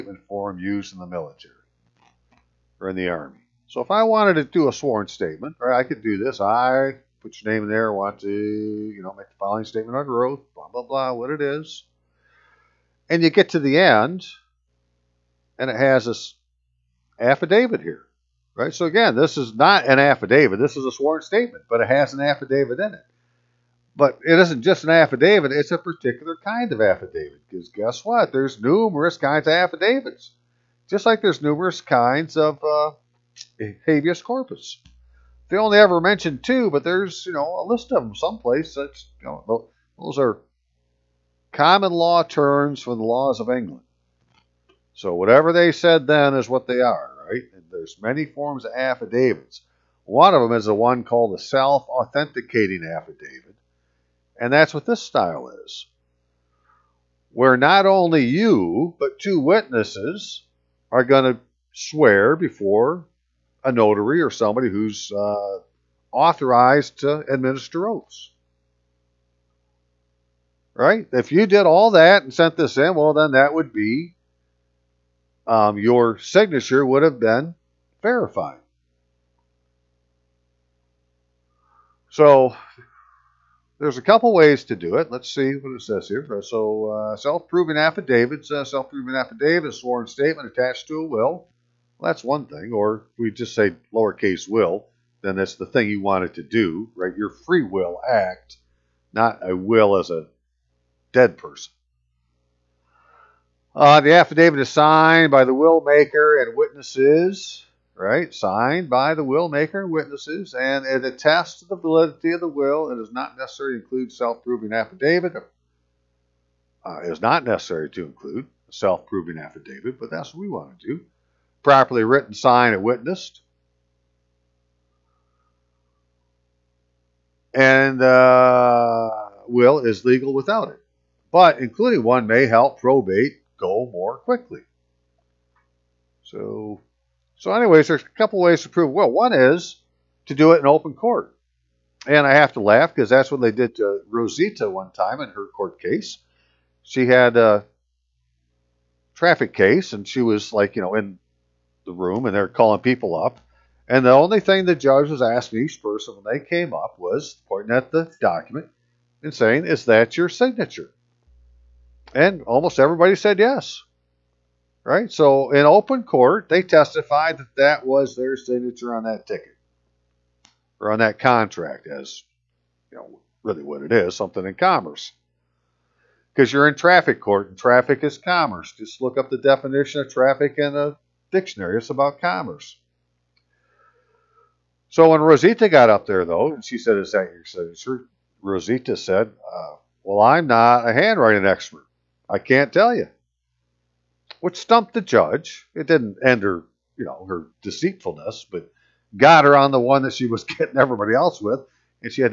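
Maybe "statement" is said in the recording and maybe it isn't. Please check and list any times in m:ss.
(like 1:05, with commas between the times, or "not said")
0:05, 0:09, 0:21, 1:30.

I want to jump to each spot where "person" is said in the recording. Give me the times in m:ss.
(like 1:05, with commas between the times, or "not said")
1:41, 2:35.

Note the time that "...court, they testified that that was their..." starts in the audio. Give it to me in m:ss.
2:46.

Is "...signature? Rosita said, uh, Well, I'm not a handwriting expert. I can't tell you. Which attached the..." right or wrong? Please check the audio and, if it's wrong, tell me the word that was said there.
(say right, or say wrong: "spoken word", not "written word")
wrong: "stumped", not "attached".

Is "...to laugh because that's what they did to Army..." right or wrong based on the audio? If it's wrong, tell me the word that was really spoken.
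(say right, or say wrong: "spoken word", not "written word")
wrong: "Rosita", not "Army".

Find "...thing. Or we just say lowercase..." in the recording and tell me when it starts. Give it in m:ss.
1:32.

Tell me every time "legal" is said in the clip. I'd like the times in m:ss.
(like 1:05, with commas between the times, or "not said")
2:10.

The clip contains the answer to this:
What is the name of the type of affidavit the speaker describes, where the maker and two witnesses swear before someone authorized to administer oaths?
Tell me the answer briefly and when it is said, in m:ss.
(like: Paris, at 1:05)
self-authenticating affidavit, at 0:51.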